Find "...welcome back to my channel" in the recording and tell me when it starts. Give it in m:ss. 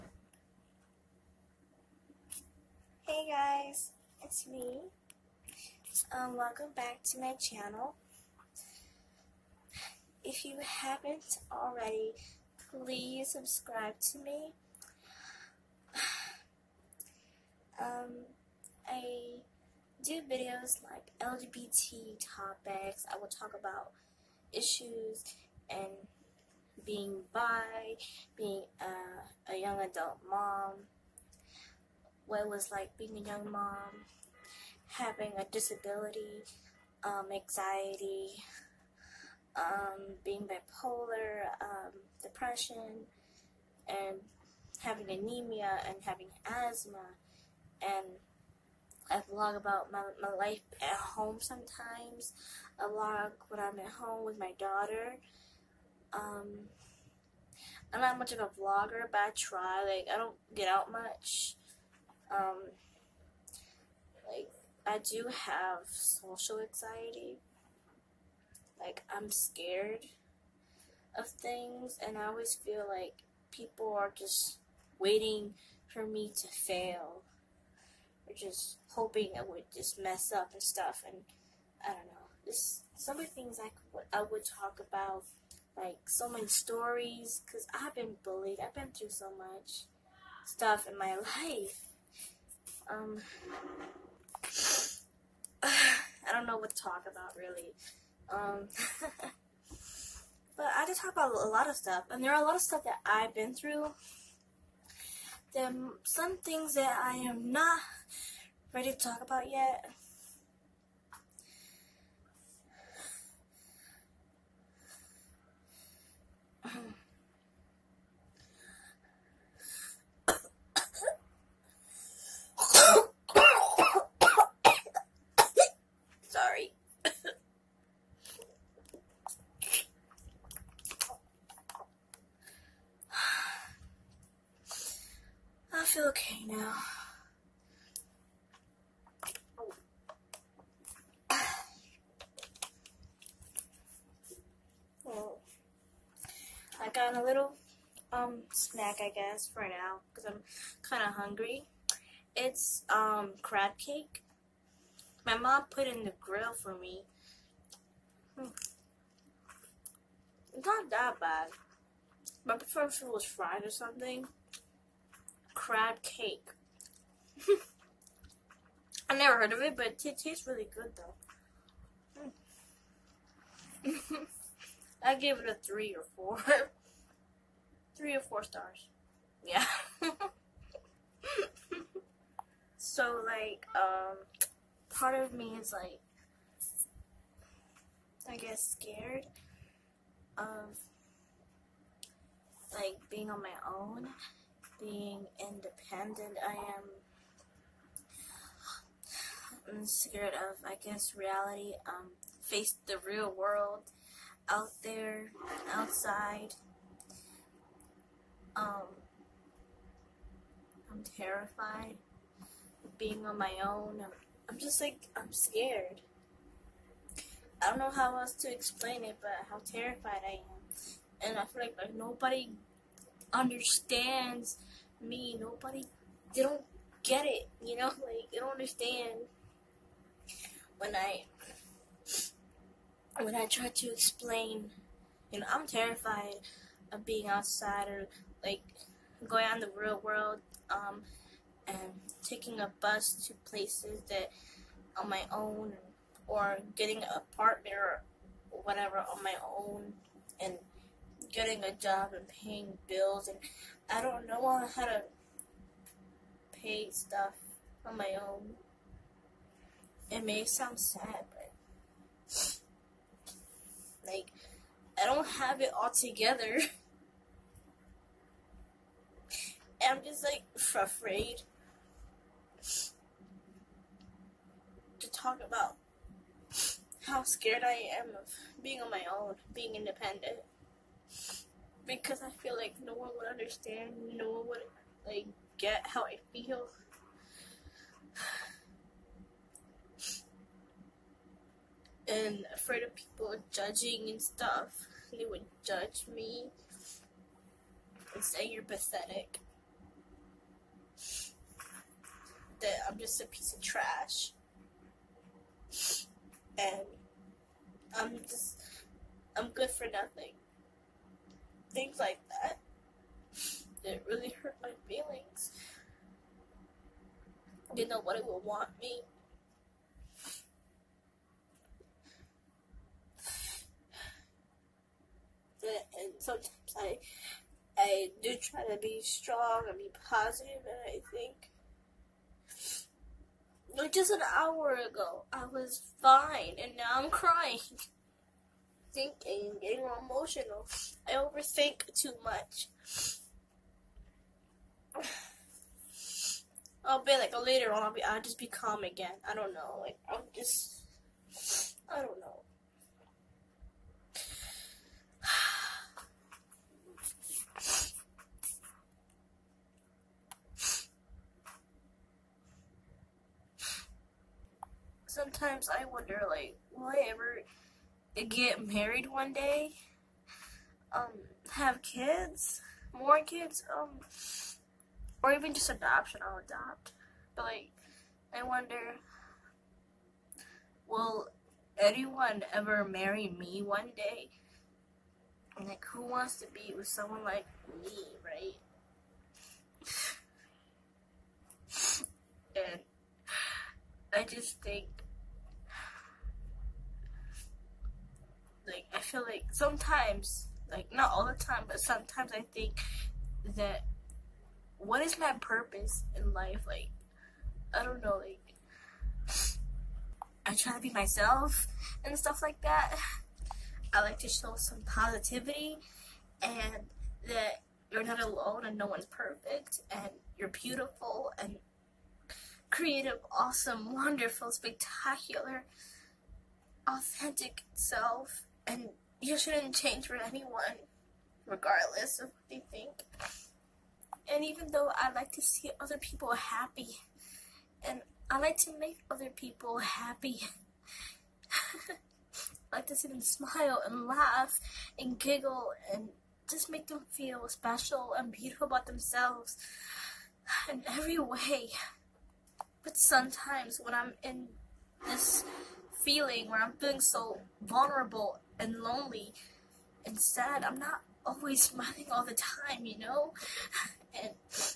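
0:06.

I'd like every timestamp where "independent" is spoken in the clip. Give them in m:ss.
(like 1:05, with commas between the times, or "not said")
3:15, 4:39.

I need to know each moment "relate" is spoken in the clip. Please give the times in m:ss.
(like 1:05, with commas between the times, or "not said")
not said.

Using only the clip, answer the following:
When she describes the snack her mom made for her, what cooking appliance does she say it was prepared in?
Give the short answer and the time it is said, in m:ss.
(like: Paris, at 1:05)
grill, at 2:36.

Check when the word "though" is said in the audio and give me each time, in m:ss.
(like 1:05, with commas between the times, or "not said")
2:53, 7:14.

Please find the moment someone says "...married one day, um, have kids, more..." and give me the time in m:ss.
6:08.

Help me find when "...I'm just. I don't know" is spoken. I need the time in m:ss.
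5:50.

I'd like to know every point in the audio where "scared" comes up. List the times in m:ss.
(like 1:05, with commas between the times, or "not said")
1:09, 3:08, 3:19, 3:35, 4:37.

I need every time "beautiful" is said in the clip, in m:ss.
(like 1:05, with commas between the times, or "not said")
7:00, 7:28.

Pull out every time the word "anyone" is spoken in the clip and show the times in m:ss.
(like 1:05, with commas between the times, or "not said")
6:21, 7:10.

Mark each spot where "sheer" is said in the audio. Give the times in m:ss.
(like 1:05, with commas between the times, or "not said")
not said.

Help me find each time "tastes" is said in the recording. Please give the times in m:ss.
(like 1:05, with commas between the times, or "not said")
2:50.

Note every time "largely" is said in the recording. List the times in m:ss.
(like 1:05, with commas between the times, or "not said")
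not said.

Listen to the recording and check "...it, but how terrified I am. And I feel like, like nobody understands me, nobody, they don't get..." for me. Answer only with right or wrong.
right.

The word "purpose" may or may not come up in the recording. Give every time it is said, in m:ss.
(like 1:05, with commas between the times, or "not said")
6:45.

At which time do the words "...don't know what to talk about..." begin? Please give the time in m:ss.
1:36.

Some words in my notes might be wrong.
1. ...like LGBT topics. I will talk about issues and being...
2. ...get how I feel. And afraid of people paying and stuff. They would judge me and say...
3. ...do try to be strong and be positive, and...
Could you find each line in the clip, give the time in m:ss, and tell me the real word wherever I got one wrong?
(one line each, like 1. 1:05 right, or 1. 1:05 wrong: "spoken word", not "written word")
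1. 0:20 right
2. 4:45 wrong: "judging", not "paying"
3. 5:28 right.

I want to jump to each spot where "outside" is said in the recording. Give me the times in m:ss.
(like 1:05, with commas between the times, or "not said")
3:25, 3:57.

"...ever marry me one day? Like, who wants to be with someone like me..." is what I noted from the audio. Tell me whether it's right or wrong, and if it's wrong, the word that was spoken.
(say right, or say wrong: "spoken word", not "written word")
right.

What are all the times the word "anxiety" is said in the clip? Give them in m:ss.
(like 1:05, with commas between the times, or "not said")
0:37, 1:06.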